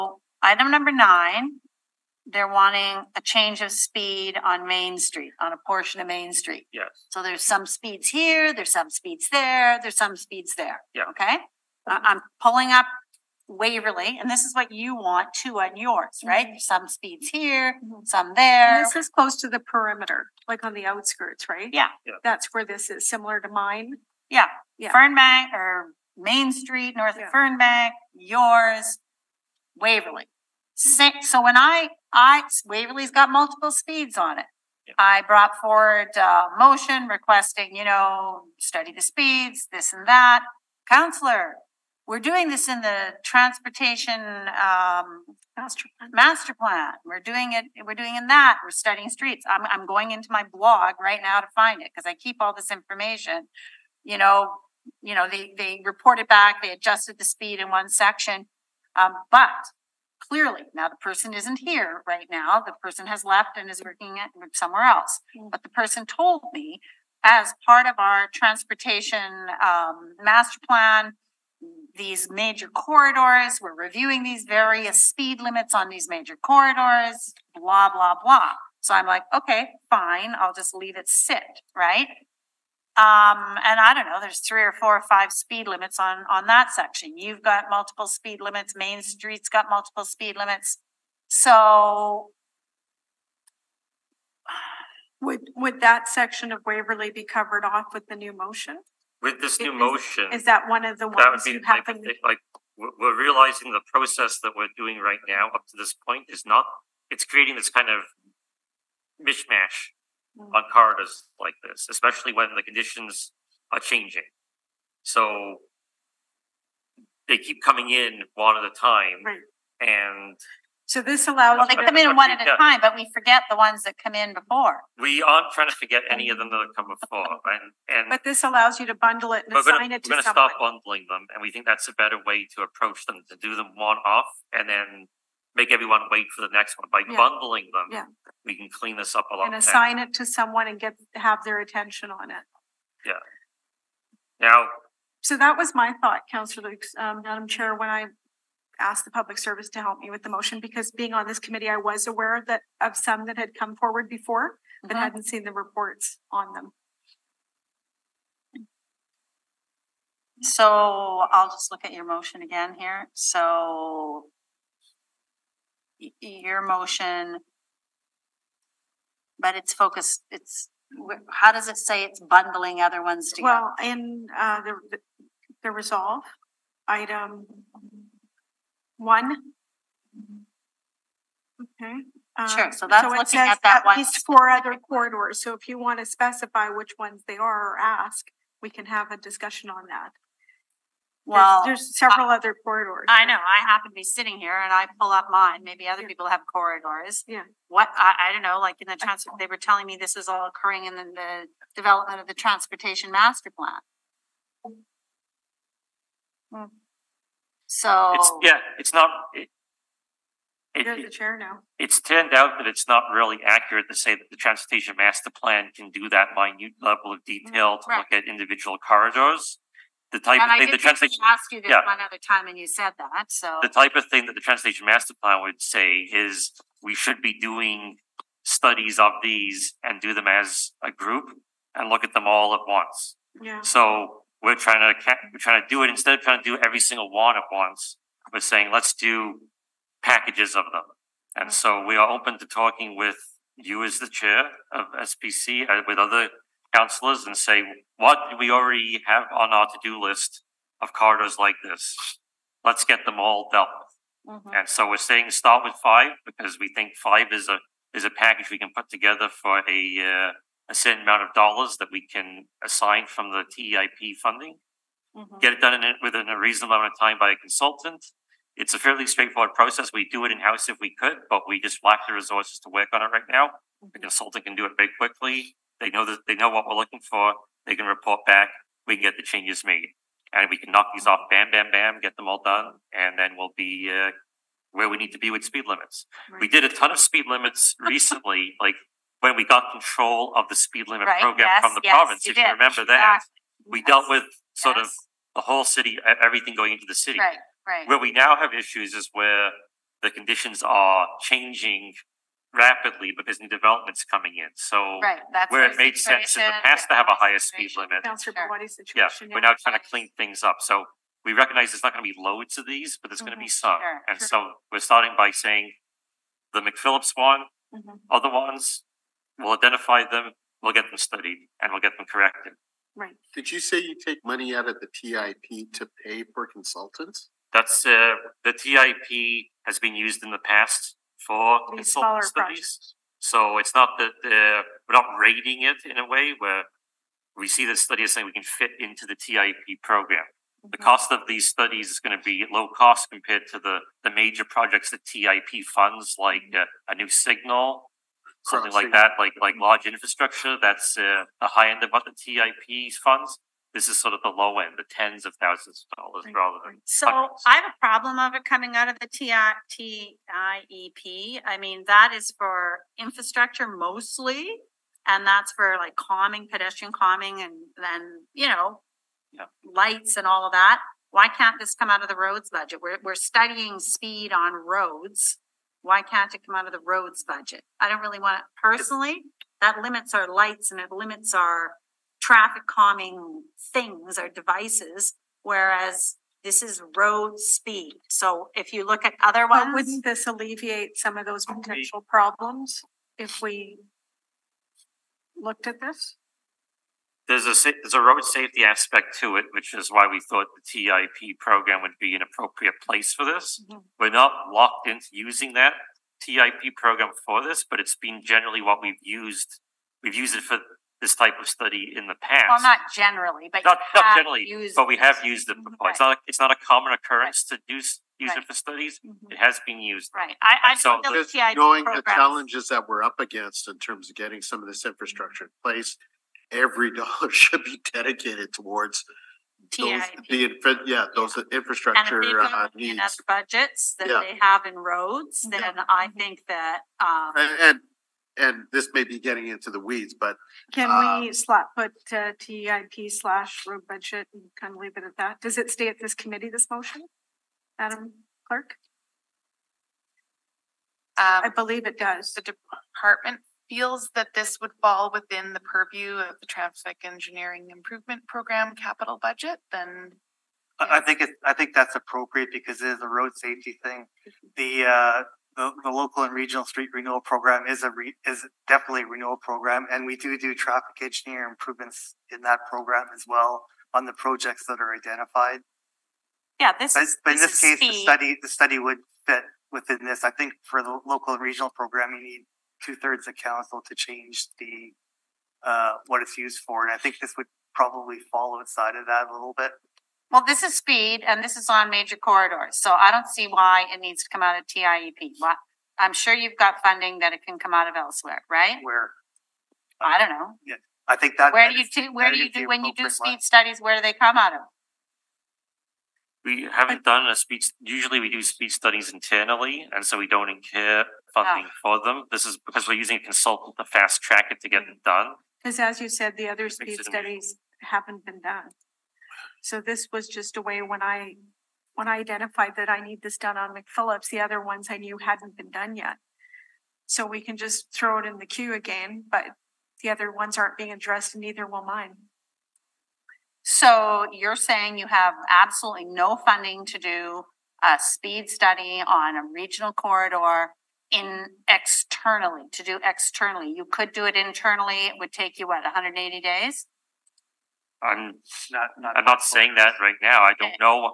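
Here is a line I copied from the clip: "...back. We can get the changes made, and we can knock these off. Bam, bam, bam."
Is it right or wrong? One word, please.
right.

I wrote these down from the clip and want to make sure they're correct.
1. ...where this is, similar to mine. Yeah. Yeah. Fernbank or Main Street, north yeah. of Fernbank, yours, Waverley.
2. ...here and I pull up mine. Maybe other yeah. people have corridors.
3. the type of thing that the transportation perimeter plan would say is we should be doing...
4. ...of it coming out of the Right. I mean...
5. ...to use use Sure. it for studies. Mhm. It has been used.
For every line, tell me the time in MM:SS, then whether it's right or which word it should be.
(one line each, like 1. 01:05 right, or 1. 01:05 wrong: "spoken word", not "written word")
1. 00:22 right
2. 03:14 right
3. 03:43 wrong: "master", not "perimeter"
4. 05:58 wrong: "TEIP", not "Right"
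5. 06:57 wrong: "Right", not "Sure".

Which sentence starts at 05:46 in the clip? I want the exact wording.
uh, a new signal, something like that, like like mm-hmm.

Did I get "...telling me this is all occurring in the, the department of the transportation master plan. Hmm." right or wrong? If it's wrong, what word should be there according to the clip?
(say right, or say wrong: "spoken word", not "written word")
wrong: "development", not "department".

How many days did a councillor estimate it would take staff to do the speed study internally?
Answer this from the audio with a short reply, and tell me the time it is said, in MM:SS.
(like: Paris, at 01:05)
180, at 09:05.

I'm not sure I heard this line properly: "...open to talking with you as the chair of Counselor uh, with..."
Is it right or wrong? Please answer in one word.
wrong.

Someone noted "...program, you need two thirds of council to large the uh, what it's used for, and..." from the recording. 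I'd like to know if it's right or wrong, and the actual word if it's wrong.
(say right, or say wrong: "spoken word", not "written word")
wrong: "change", not "large".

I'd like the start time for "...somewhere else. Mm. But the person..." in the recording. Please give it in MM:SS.
01:04.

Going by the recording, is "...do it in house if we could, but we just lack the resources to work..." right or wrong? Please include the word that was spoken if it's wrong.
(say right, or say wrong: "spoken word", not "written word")
right.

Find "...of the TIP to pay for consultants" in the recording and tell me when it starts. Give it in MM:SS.
05:24.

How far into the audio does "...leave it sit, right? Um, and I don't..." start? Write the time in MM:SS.
01:20.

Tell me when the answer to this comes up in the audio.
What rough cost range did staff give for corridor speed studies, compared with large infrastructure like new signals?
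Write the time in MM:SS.
05:54.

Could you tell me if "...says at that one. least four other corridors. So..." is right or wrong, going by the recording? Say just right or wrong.
right.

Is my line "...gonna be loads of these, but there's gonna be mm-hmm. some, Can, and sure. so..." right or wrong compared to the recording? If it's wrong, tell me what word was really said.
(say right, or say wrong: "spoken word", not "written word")
wrong: "Sure", not "Can".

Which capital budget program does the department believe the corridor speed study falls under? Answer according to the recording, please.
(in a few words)
traffic engineering improvement program.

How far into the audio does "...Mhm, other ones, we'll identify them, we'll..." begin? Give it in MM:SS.
05:17.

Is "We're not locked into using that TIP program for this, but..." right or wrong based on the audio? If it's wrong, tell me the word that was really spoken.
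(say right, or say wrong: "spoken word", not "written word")
right.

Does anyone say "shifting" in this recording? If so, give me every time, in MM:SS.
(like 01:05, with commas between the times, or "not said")
not said.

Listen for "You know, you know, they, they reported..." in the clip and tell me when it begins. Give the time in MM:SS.
00:54.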